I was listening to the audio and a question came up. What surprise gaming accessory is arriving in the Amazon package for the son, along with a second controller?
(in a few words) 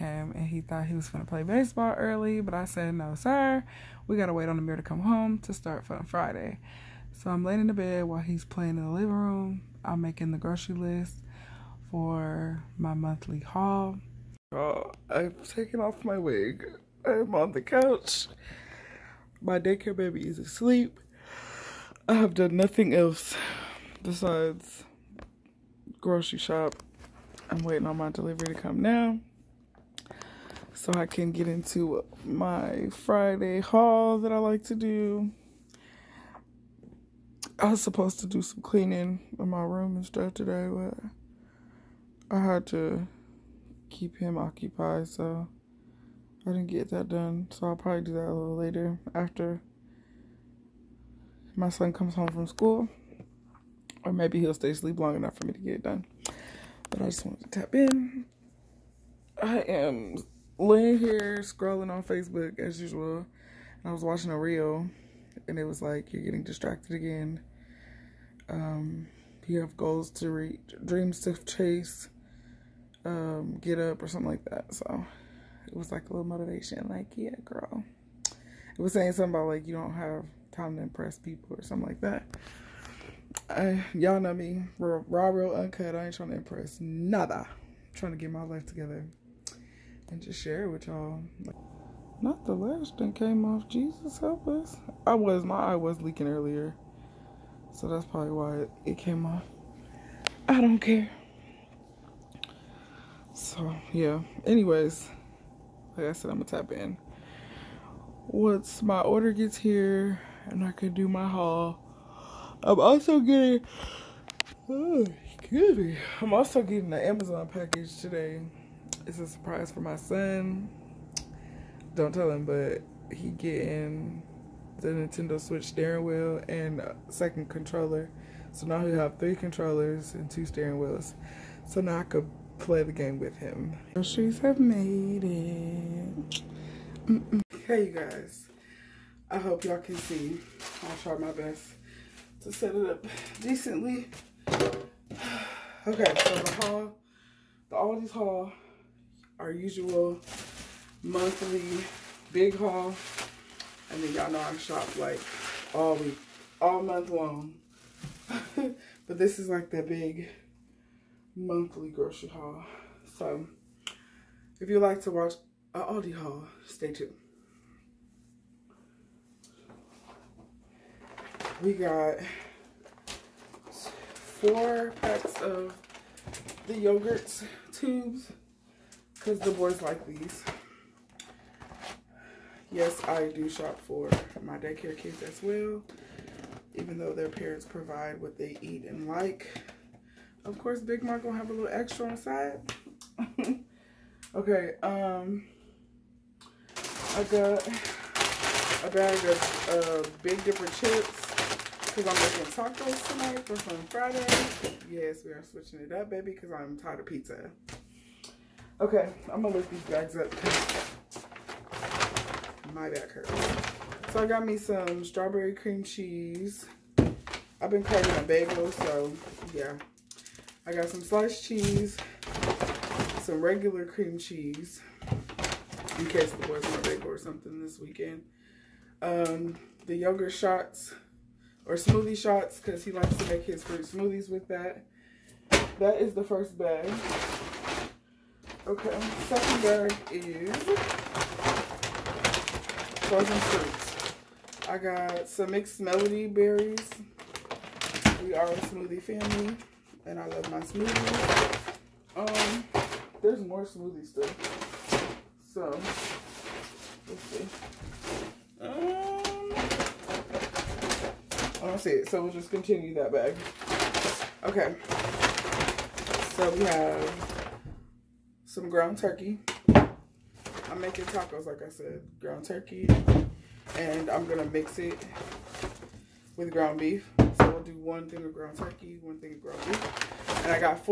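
Nintendo Switch steering wheel.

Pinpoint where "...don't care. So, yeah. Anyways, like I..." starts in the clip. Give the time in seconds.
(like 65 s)
100 s.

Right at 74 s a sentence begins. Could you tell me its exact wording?
So it was like a little motivation, like, yeah, girl.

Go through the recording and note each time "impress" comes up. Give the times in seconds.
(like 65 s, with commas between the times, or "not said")
80 s, 86 s.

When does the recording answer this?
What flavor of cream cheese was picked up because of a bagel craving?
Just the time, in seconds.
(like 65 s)
215 s.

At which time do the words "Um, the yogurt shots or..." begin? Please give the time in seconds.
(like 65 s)
229 s.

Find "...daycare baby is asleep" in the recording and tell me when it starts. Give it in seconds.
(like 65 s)
19 s.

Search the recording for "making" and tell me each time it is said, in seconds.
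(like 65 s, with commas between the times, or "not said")
9 s, 202 s, 270 s.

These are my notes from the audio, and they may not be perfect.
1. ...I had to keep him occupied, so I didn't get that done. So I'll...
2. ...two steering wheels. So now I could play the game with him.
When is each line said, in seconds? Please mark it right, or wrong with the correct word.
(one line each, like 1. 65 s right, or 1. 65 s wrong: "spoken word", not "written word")
1. 42 s right
2. 130 s right.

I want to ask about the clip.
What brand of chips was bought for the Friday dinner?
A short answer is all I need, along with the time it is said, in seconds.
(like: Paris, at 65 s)
Big Dipper, at 200 s.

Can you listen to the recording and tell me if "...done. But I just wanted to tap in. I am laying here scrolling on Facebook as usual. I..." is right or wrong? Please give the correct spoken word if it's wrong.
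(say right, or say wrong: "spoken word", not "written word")
right.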